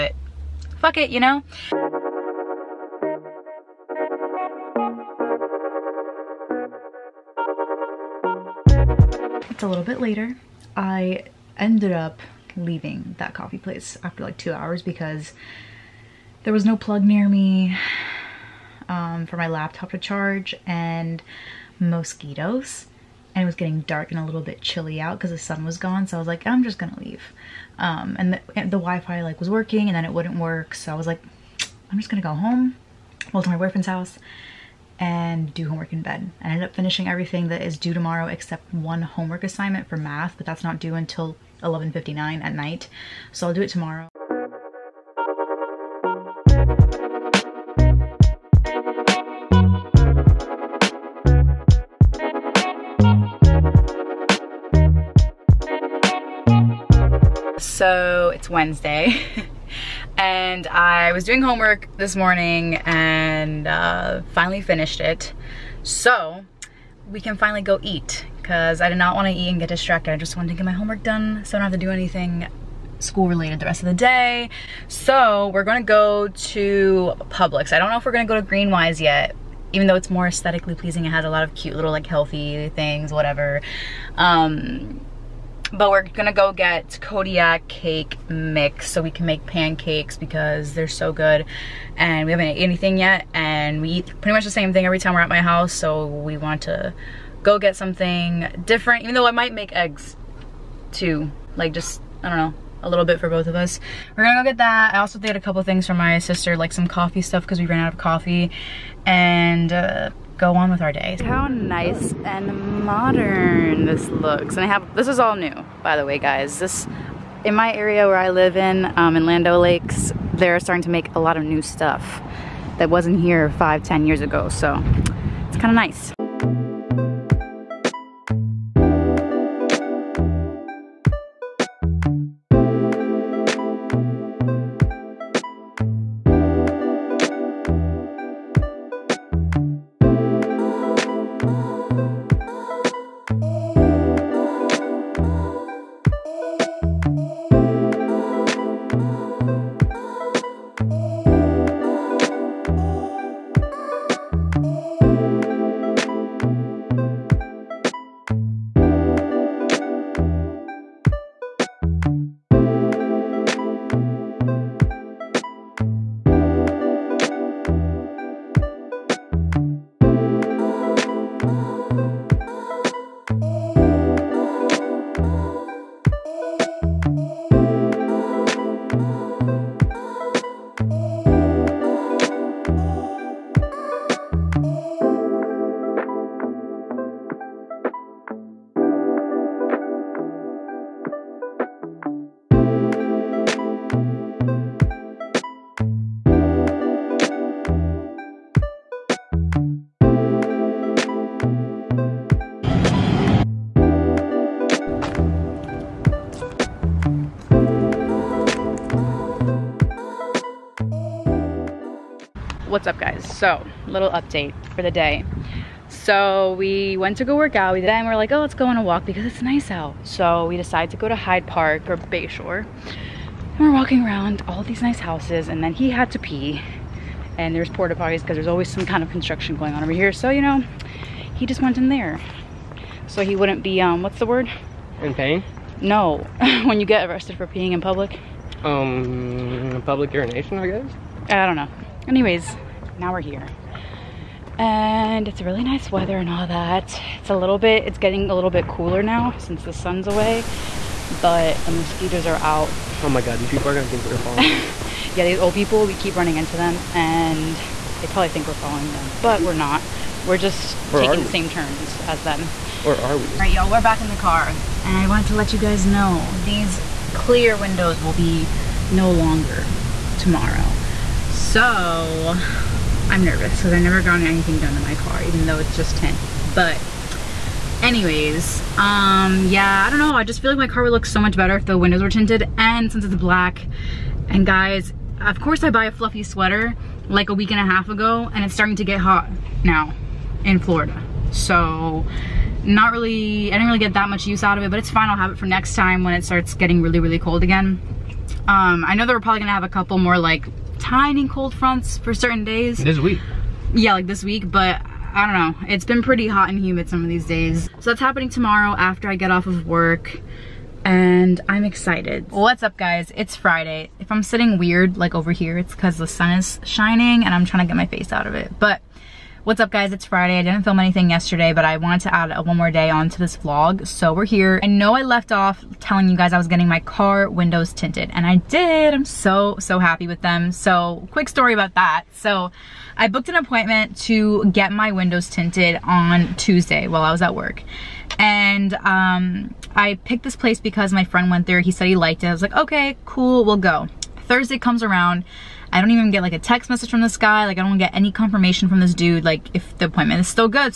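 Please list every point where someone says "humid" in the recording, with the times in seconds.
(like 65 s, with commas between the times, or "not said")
306 s.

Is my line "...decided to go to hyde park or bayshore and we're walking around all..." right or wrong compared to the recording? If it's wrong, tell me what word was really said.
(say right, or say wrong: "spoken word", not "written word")
right.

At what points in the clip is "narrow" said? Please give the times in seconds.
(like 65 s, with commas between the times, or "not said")
not said.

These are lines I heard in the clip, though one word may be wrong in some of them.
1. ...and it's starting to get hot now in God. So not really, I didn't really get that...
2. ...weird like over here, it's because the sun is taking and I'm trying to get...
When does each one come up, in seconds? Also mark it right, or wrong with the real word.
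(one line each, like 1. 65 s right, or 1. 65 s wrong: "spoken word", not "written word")
1. 288 s wrong: "Florida", not "God"
2. 314 s wrong: "shining", not "taking".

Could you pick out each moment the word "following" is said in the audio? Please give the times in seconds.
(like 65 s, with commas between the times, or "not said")
254 s, 258 s.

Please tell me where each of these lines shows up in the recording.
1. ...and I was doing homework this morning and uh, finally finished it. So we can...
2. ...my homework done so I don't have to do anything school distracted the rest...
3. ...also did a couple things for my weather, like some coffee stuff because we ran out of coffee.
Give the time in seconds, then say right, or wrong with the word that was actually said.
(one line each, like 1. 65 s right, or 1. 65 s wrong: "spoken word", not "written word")
1. 60 s right
2. 70 s wrong: "related", not "distracted"
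3. 104 s wrong: "sister", not "weather".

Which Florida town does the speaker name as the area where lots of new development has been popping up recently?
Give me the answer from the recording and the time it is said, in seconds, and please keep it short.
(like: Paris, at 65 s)
Land O' Lakes, at 119 s.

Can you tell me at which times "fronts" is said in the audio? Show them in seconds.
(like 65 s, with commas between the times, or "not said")
301 s.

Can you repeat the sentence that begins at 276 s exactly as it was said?
But anyways, um, yeah, I don't know.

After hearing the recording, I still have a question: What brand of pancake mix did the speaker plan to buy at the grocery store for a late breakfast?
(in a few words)
Kodiak.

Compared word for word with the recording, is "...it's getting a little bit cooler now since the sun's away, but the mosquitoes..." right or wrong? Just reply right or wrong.
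right.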